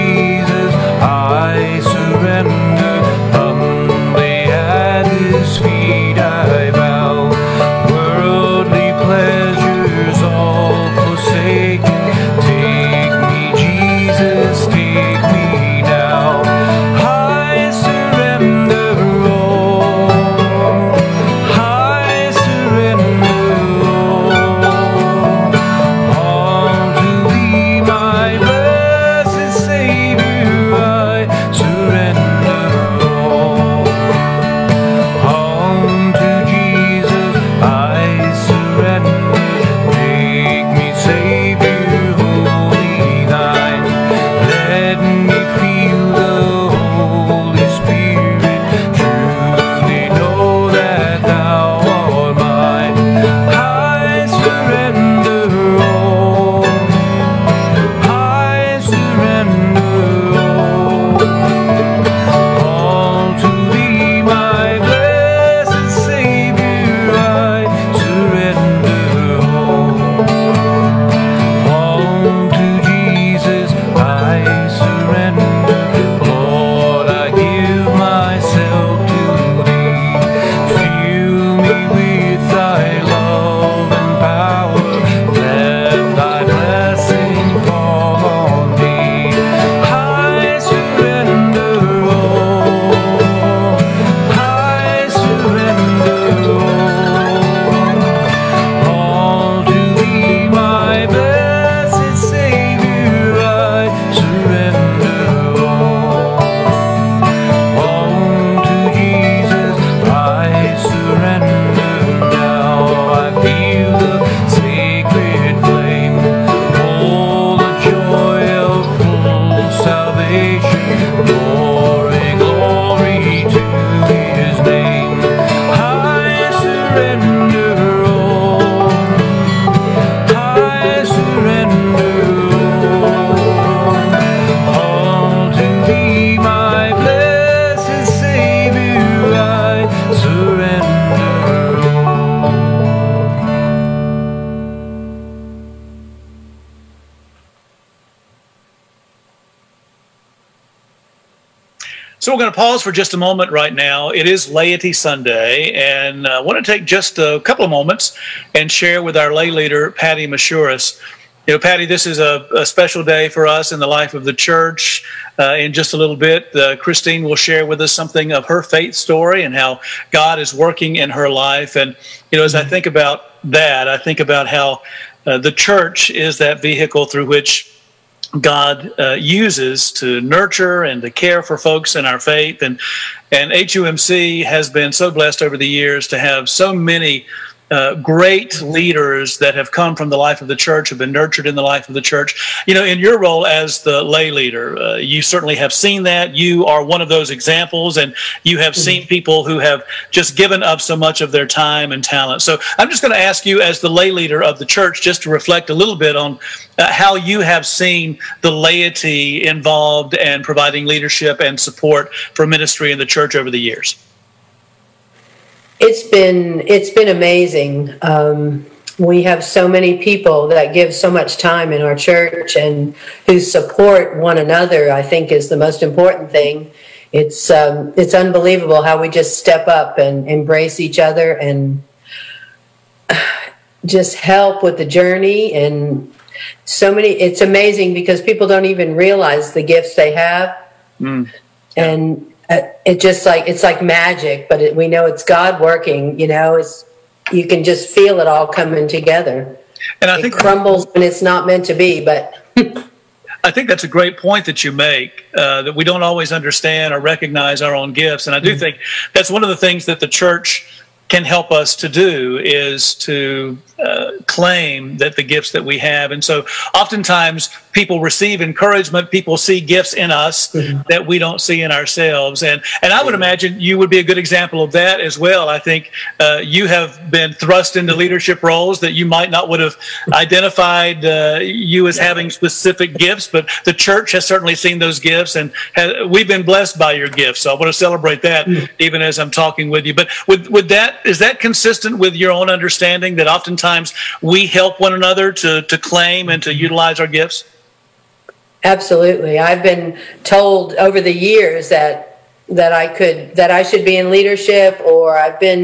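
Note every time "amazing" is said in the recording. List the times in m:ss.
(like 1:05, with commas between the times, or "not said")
3:37, 3:57.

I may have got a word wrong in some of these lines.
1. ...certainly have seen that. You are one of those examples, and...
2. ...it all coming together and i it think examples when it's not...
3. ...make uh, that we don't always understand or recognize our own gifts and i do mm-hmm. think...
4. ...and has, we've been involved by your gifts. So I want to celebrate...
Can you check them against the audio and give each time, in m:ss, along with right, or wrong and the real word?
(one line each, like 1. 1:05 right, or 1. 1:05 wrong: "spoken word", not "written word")
1. 3:15 right
2. 4:08 wrong: "crumbles", not "examples"
3. 4:14 right
4. 4:45 wrong: "blessed", not "involved".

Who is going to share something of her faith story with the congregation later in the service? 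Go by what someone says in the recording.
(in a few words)
Christine.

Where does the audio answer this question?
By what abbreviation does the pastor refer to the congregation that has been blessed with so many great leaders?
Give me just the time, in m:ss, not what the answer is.
3:03.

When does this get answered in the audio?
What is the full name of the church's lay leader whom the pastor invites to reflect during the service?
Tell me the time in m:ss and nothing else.
2:39.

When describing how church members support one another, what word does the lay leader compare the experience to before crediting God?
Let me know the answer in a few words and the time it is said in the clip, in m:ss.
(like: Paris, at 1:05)
magic, at 4:03.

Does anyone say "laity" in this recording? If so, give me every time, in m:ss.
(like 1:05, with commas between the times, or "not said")
2:34, 3:28.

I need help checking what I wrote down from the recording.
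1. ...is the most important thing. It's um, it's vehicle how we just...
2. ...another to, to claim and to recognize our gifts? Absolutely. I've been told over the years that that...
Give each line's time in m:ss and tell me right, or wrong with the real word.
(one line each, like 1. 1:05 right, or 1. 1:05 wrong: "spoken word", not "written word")
1. 3:45 wrong: "unbelievable", not "vehicle"
2. 4:54 wrong: "utilize", not "recognize".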